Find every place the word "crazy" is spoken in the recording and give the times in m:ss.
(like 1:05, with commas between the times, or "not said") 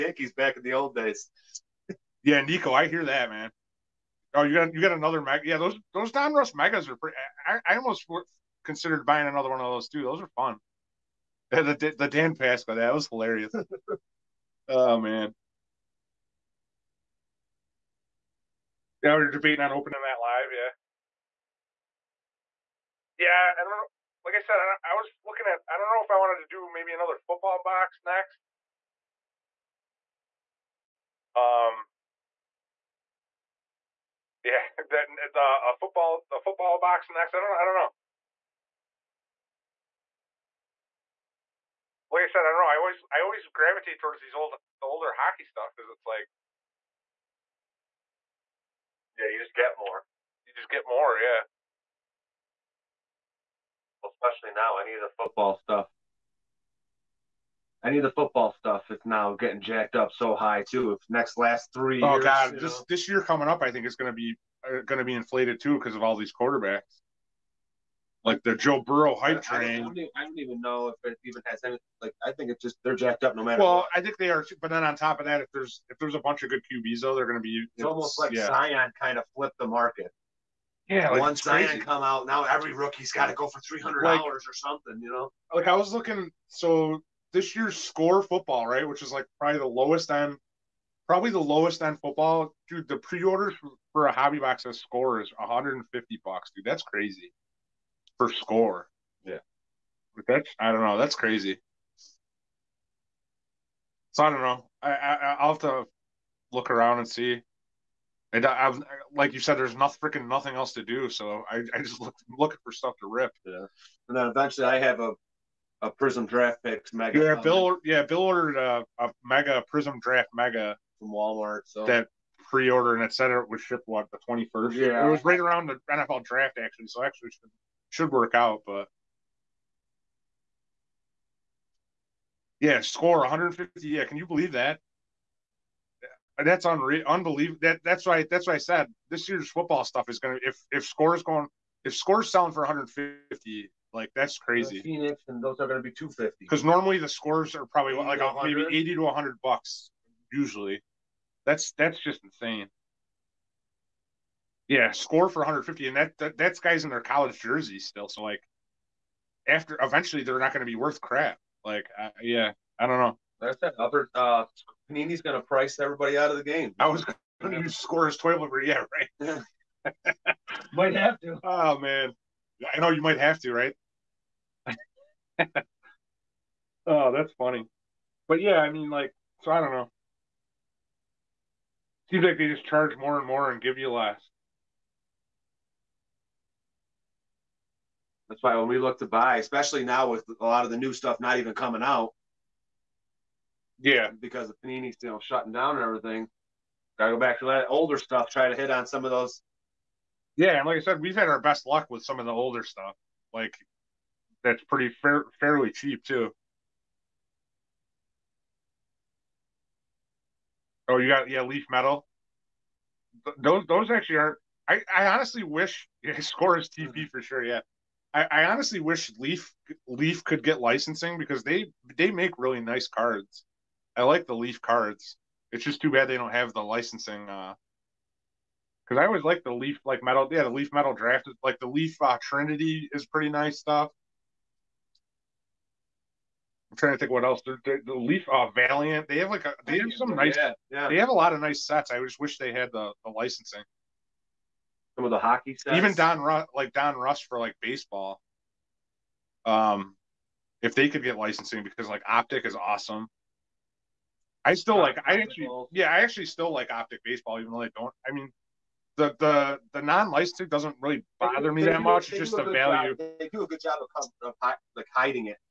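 1:36, 1:41, 2:24.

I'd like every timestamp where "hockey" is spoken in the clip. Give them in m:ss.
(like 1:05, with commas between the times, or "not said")
0:45, 4:05.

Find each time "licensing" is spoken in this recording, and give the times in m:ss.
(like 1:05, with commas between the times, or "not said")
3:40, 3:46, 4:03, 4:11, 4:20.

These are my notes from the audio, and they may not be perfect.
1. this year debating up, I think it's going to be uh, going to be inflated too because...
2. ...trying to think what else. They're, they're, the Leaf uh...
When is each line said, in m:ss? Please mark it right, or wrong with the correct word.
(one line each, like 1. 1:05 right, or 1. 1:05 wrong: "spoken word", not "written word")
1. 1:02 wrong: "coming", not "debating"
2. 3:56 right.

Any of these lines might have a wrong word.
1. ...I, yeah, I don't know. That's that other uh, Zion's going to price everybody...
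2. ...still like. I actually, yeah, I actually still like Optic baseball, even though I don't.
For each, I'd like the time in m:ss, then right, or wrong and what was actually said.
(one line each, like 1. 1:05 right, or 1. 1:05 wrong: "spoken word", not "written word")
1. 2:41 wrong: "Panini", not "Zion"
2. 4:14 right.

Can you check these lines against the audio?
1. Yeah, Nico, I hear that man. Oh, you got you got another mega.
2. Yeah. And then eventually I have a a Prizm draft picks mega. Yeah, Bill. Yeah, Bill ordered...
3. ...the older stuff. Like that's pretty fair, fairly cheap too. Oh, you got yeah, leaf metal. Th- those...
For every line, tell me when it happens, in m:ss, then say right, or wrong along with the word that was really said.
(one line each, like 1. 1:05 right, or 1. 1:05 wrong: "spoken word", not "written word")
1. 0:02 right
2. 1:53 right
3. 3:22 right.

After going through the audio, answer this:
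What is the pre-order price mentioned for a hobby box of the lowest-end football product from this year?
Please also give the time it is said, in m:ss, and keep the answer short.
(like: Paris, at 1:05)
$150, at 1:35.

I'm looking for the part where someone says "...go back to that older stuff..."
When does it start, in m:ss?
3:17.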